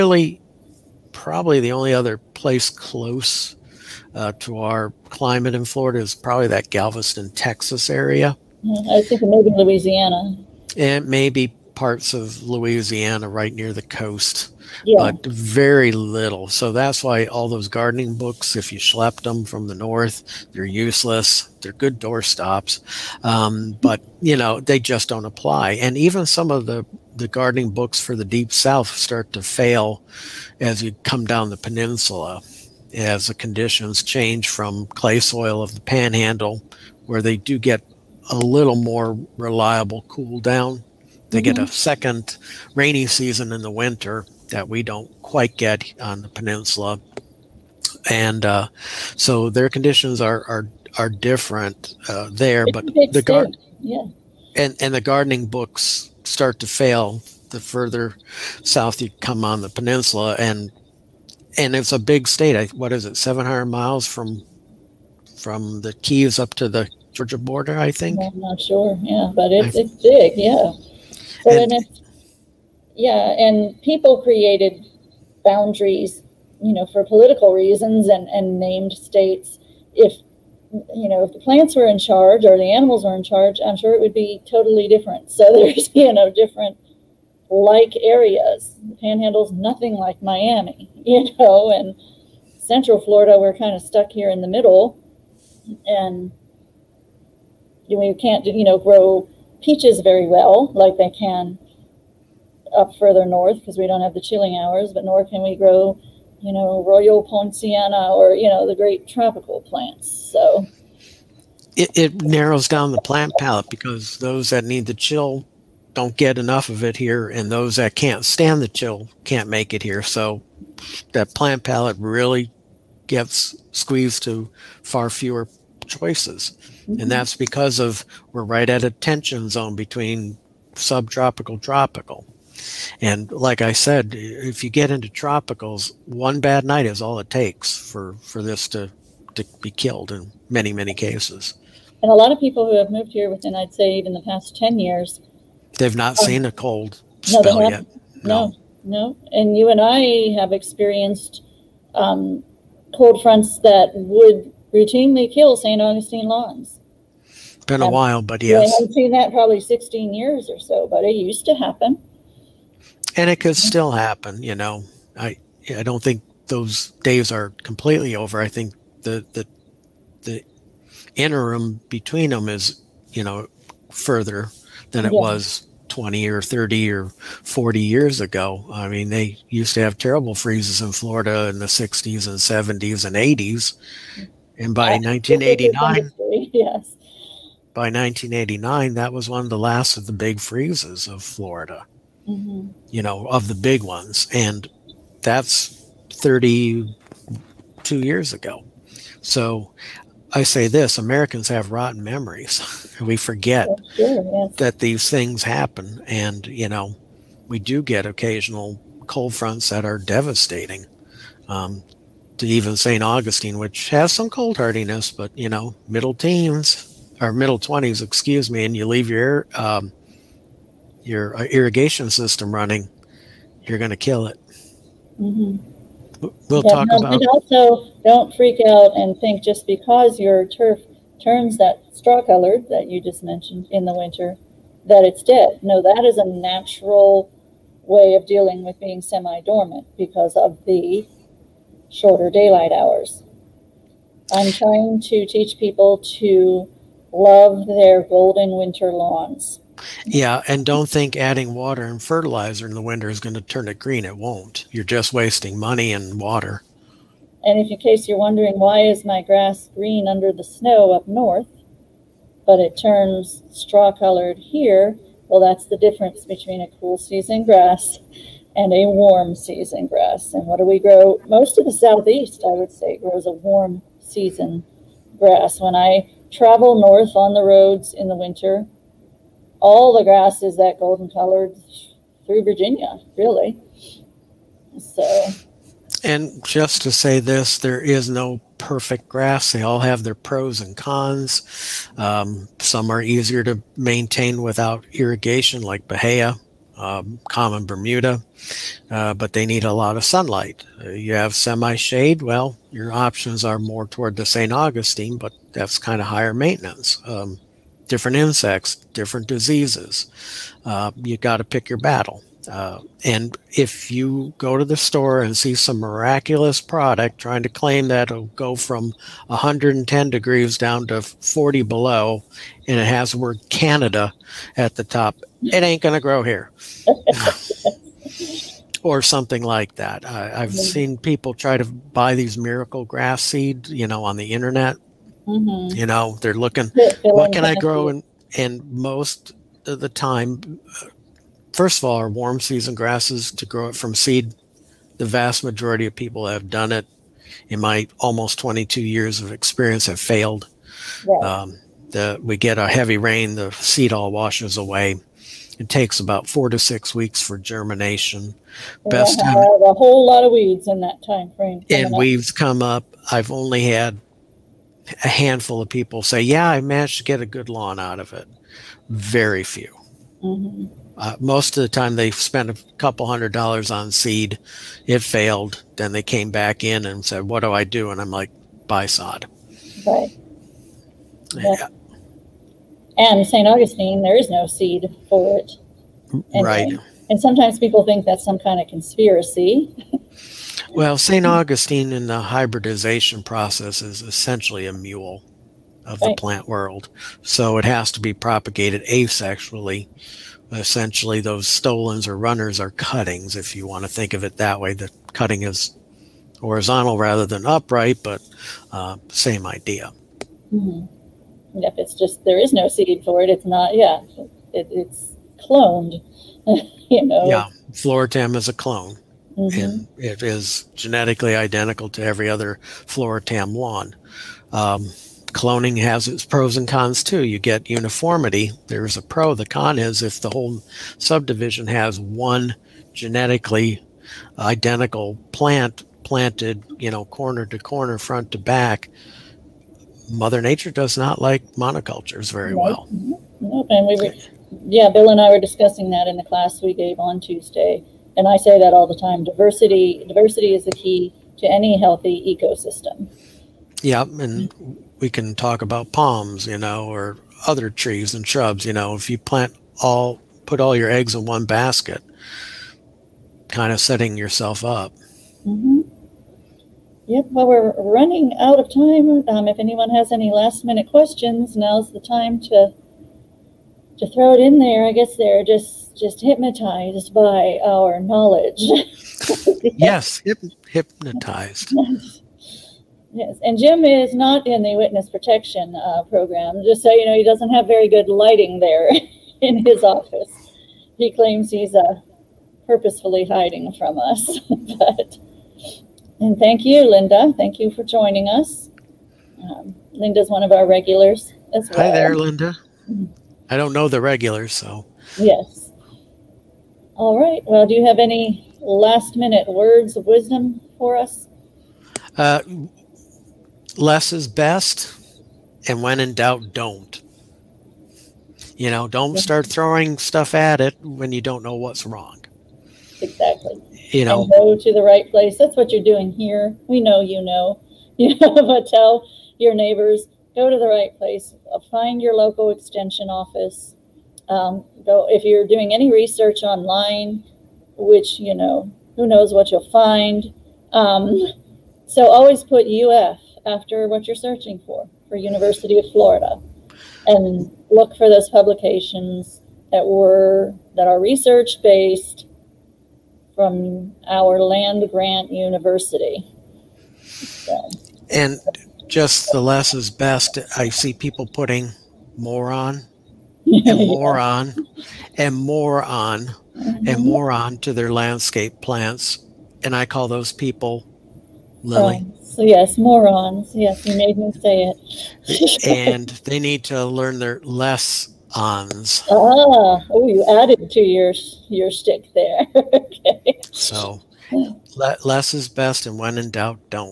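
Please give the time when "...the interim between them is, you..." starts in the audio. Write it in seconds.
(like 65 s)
170 s.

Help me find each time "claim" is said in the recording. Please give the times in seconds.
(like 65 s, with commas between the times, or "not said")
317 s, 491 s.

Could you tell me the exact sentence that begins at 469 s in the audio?
Um, if anyone has any last minute questions, now's the time to to throw it in there.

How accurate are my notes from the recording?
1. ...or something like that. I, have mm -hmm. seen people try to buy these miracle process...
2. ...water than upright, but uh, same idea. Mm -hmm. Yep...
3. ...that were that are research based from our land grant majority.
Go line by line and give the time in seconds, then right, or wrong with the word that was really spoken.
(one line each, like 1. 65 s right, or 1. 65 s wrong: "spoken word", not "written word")
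1. 328 s wrong: "grass", not "process"
2. 406 s wrong: "rather", not "water"
3. 549 s wrong: "university", not "majority".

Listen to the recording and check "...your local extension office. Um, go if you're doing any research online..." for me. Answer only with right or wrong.
right.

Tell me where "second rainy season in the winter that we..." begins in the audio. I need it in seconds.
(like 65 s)
41 s.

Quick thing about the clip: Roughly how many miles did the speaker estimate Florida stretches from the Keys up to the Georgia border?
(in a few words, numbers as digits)
700.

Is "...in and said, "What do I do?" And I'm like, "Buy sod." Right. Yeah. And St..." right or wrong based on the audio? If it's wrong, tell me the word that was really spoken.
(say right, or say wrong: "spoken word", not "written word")
right.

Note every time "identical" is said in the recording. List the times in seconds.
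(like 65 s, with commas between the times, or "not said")
421 s, 434 s.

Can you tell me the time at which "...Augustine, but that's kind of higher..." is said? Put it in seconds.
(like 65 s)
304 s.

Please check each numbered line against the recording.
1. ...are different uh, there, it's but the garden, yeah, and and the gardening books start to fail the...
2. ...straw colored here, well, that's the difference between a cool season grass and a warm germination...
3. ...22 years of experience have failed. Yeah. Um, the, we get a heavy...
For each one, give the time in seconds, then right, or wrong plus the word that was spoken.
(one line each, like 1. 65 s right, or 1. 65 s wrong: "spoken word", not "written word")
1. 50 s right
2. 263 s wrong: "season", not "germination"
3. 348 s right.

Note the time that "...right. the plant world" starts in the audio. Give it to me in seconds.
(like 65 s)
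396 s.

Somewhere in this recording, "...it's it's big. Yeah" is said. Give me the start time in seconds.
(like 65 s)
69 s.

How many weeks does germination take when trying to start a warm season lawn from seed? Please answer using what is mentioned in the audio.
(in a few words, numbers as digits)
4 to 6 weeks.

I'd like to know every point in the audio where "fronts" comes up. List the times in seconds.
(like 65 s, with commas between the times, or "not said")
153 s, 209 s, 437 s.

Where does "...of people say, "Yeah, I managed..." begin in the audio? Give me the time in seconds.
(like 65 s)
365 s.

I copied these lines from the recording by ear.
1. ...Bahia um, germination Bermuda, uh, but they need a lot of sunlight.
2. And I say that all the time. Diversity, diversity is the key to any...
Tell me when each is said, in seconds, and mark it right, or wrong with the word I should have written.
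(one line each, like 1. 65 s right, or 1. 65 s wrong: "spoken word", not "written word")
1. 295 s wrong: "common", not "germination"
2. 448 s right.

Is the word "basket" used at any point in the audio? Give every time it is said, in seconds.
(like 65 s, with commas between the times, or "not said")
461 s.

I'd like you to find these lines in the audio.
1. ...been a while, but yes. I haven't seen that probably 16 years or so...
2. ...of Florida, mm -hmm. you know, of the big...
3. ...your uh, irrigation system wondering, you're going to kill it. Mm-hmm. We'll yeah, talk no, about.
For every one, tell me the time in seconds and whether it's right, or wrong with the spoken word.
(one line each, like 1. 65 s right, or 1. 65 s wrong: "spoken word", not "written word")
1. 157 s right
2. 191 s right
3. 221 s wrong: "running", not "wondering".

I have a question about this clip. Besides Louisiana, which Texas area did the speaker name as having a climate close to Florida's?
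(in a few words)
Galveston.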